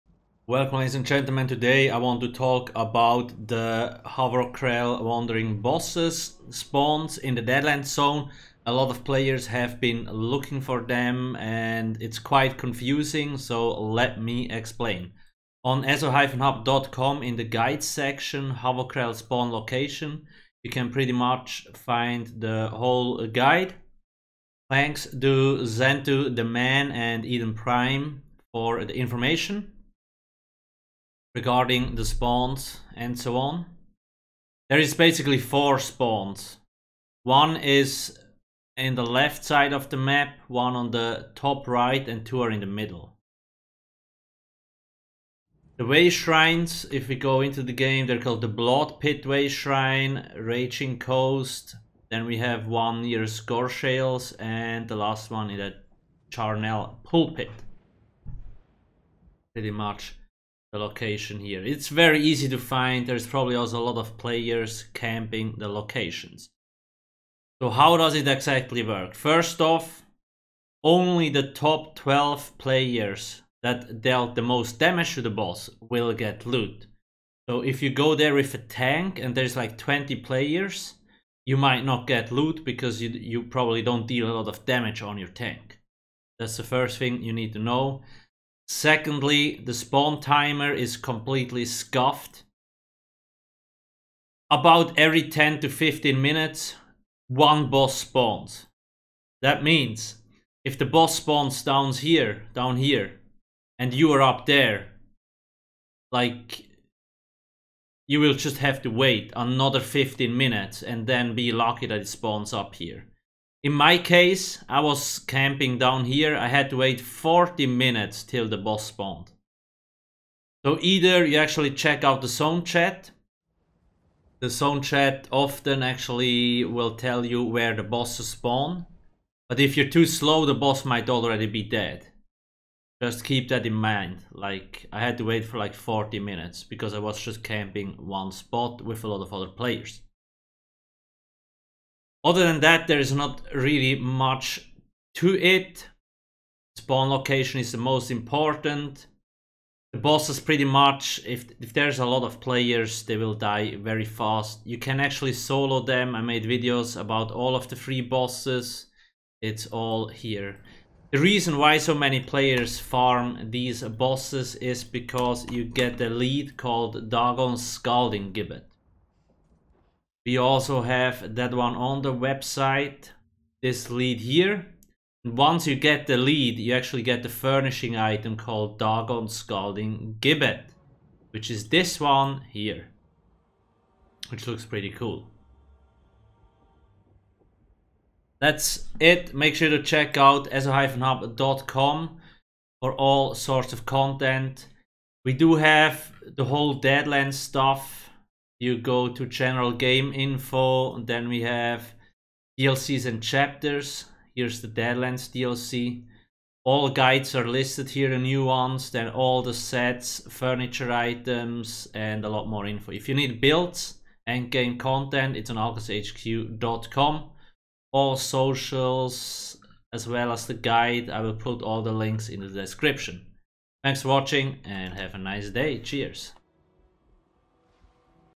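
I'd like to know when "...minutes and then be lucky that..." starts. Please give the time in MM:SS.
01:50.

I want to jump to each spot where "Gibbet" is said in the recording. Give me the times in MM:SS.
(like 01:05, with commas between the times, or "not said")
02:48, 03:00.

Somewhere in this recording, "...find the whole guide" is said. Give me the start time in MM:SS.
00:21.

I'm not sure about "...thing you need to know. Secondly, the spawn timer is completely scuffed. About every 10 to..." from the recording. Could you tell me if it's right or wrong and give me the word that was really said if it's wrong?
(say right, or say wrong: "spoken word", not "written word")
right.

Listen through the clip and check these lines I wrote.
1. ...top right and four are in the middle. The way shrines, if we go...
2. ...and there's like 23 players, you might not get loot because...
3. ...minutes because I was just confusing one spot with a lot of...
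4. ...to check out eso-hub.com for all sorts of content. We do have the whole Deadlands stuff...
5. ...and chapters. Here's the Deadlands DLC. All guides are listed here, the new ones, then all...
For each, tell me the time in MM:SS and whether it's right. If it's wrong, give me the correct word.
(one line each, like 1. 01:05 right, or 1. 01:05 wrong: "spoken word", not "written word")
1. 00:41 wrong: "two", not "four"
2. 01:19 wrong: "20", not "23"
3. 02:16 wrong: "camping", not "confusing"
4. 03:09 right
5. 03:23 right.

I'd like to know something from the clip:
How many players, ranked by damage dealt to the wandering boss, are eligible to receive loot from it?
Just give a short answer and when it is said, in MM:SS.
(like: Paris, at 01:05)
12, at 01:11.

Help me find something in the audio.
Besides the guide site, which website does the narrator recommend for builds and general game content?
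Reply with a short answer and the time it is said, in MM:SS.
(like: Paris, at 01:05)
alcasthq.com, at 03:35.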